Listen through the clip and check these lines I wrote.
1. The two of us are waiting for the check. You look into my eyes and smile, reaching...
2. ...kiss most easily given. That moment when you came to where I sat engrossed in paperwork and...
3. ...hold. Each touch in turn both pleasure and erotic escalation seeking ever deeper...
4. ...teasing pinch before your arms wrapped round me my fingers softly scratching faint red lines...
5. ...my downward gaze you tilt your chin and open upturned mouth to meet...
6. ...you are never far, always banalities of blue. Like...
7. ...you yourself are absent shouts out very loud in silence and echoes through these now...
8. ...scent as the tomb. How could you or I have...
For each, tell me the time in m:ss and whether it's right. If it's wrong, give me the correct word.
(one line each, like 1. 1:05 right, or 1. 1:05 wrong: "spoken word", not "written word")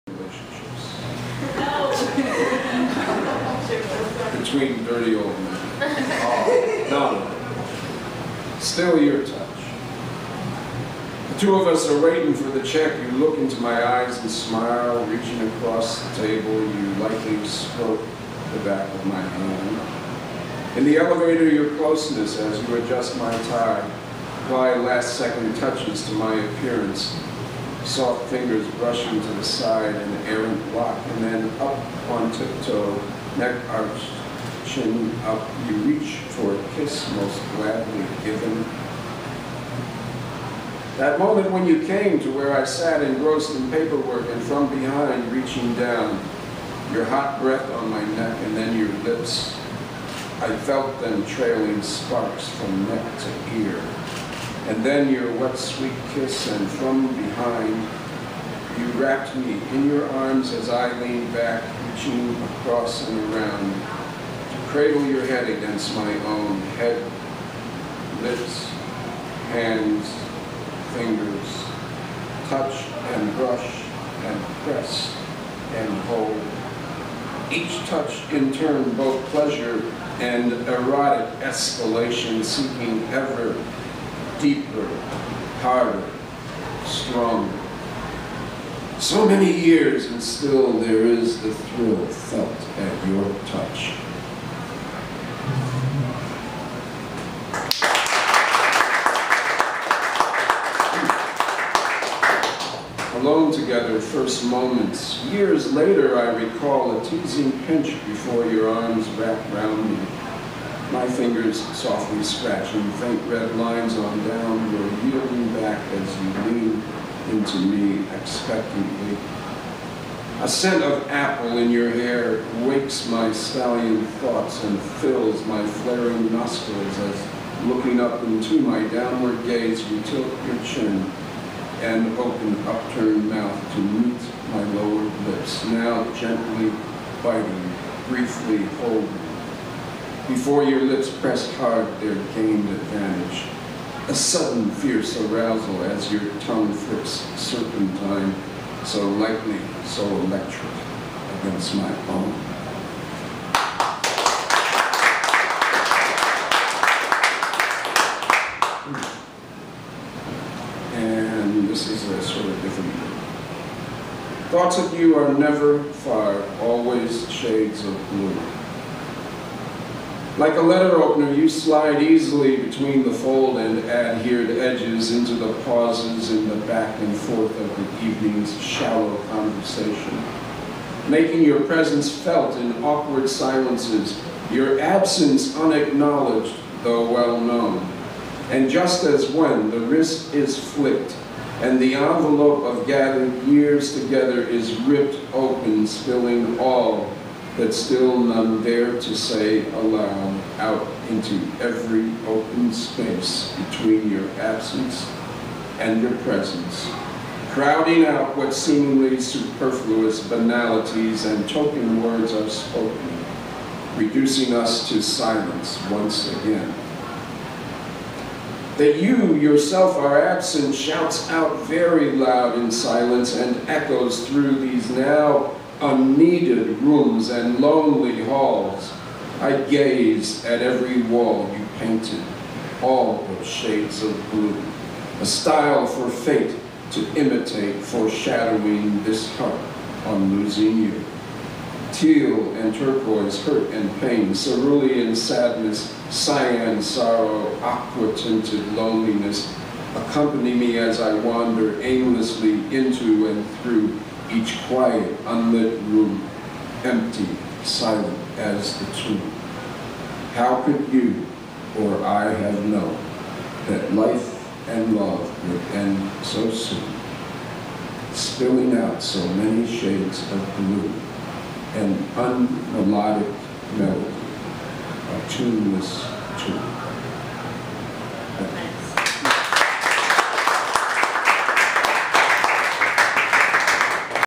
1. 0:11 right
2. 0:36 wrong: "gladly", not "easily"
3. 1:16 right
4. 1:47 right
5. 2:08 right
6. 2:44 wrong: "shades", not "banalities"
7. 3:39 right
8. 4:17 wrong: "silent", not "scent".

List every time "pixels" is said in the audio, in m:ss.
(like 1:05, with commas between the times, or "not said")
not said.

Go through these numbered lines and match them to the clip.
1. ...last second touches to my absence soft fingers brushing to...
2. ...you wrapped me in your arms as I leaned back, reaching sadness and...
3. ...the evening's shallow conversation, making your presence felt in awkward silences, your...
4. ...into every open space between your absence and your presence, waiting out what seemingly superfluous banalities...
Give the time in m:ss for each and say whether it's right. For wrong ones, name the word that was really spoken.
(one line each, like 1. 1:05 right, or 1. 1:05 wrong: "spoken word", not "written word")
1. 0:24 wrong: "appearance", not "absence"
2. 0:58 wrong: "across", not "sadness"
3. 2:57 right
4. 3:21 wrong: "crowding", not "waiting".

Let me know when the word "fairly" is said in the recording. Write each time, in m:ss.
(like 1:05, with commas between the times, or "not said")
not said.